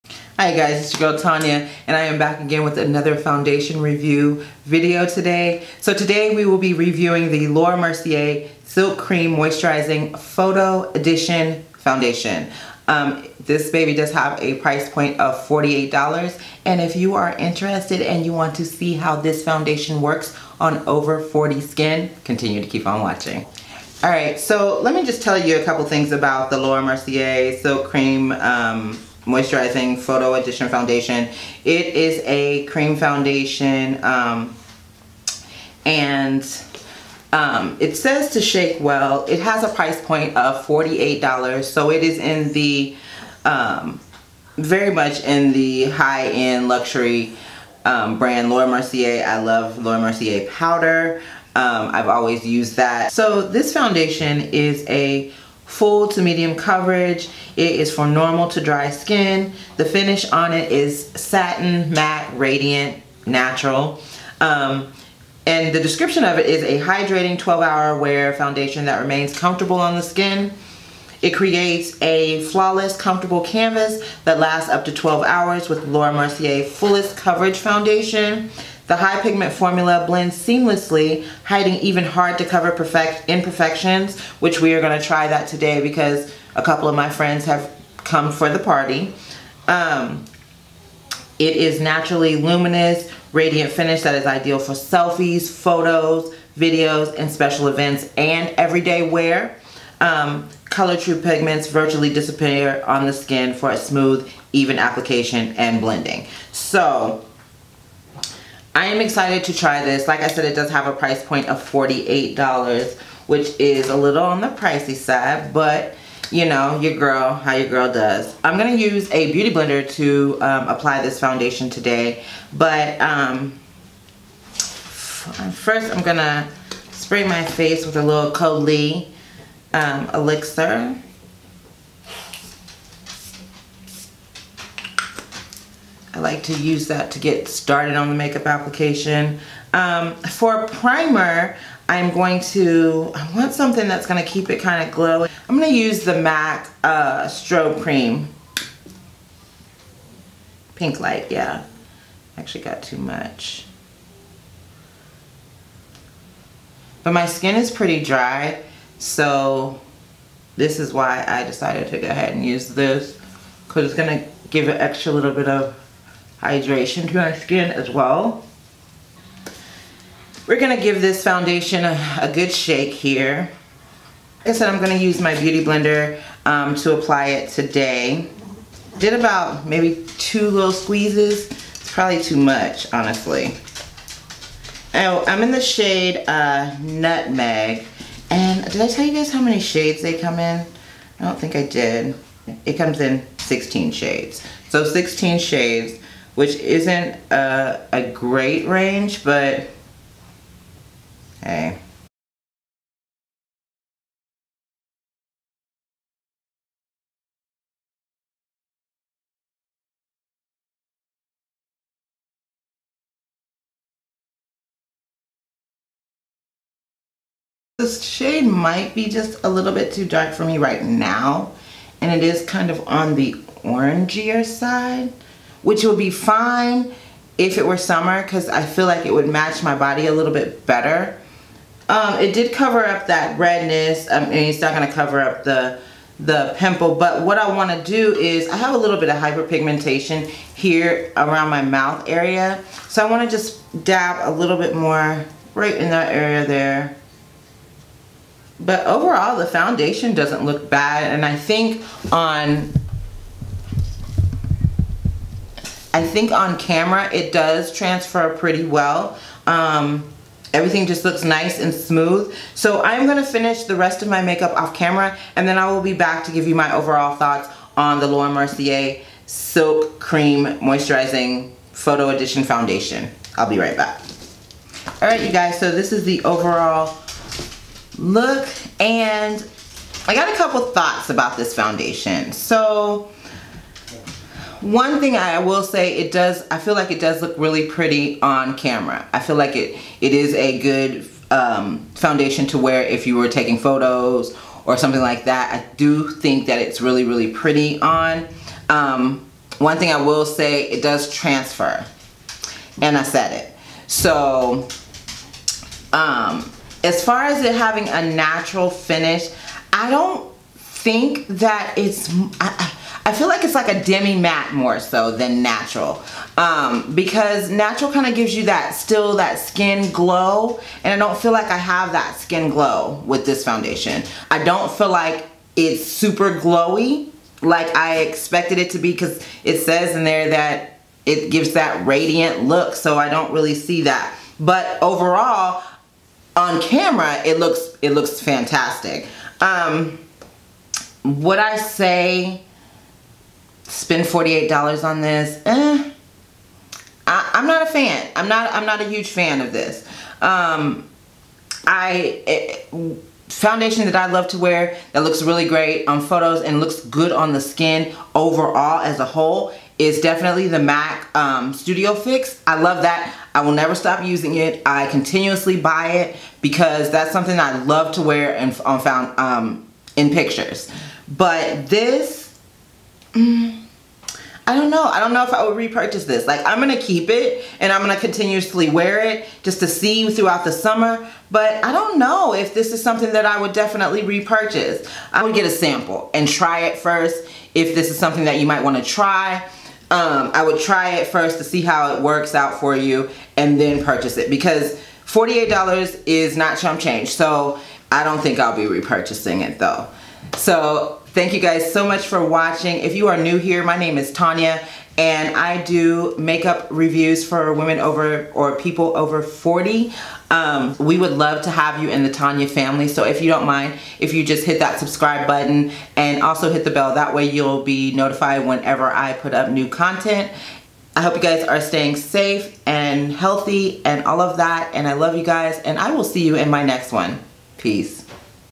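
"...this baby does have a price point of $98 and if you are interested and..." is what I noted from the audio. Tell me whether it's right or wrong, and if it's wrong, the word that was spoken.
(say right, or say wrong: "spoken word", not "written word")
wrong: "48", not "98".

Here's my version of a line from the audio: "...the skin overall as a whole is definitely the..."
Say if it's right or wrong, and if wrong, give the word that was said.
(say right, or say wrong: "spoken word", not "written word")
right.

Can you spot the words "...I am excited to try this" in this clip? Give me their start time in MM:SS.
01:48.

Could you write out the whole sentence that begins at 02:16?
I like to use that to get started on the makeup application.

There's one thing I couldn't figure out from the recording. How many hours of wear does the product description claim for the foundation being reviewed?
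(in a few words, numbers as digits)
12.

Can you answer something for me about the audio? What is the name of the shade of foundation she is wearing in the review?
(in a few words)
Nutmeg.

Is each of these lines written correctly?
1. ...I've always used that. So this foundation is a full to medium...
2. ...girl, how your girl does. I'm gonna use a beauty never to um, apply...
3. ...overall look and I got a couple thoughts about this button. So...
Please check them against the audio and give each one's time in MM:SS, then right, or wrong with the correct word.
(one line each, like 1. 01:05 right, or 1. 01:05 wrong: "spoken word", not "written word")
1. 00:51 right
2. 01:56 wrong: "blender", not "never"
3. 04:36 wrong: "foundation", not "button".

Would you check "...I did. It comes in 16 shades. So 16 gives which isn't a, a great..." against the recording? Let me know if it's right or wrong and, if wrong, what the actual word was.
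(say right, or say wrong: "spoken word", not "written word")
wrong: "shades", not "gives".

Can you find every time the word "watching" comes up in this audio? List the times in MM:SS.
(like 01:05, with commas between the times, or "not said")
00:23, 06:42.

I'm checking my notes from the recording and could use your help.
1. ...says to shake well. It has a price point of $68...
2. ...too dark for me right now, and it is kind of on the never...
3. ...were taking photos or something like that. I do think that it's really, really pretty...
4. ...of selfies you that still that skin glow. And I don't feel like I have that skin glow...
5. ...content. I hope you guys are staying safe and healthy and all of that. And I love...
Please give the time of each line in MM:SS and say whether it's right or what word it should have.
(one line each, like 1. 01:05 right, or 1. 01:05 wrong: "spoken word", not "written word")
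1. 00:37 wrong: "48", not "68"
2. 03:39 wrong: "orangier", not "never"
3. 04:53 right
4. 05:18 wrong: "gives", not "selfies"
5. 06:59 right.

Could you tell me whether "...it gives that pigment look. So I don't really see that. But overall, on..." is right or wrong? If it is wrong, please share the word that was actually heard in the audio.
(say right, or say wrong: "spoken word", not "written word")
wrong: "radiant", not "pigment".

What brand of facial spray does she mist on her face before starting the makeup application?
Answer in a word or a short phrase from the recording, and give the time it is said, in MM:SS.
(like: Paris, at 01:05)
Caudalie, at 02:08.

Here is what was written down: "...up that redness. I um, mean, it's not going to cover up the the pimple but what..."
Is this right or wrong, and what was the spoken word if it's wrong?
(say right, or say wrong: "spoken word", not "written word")
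right.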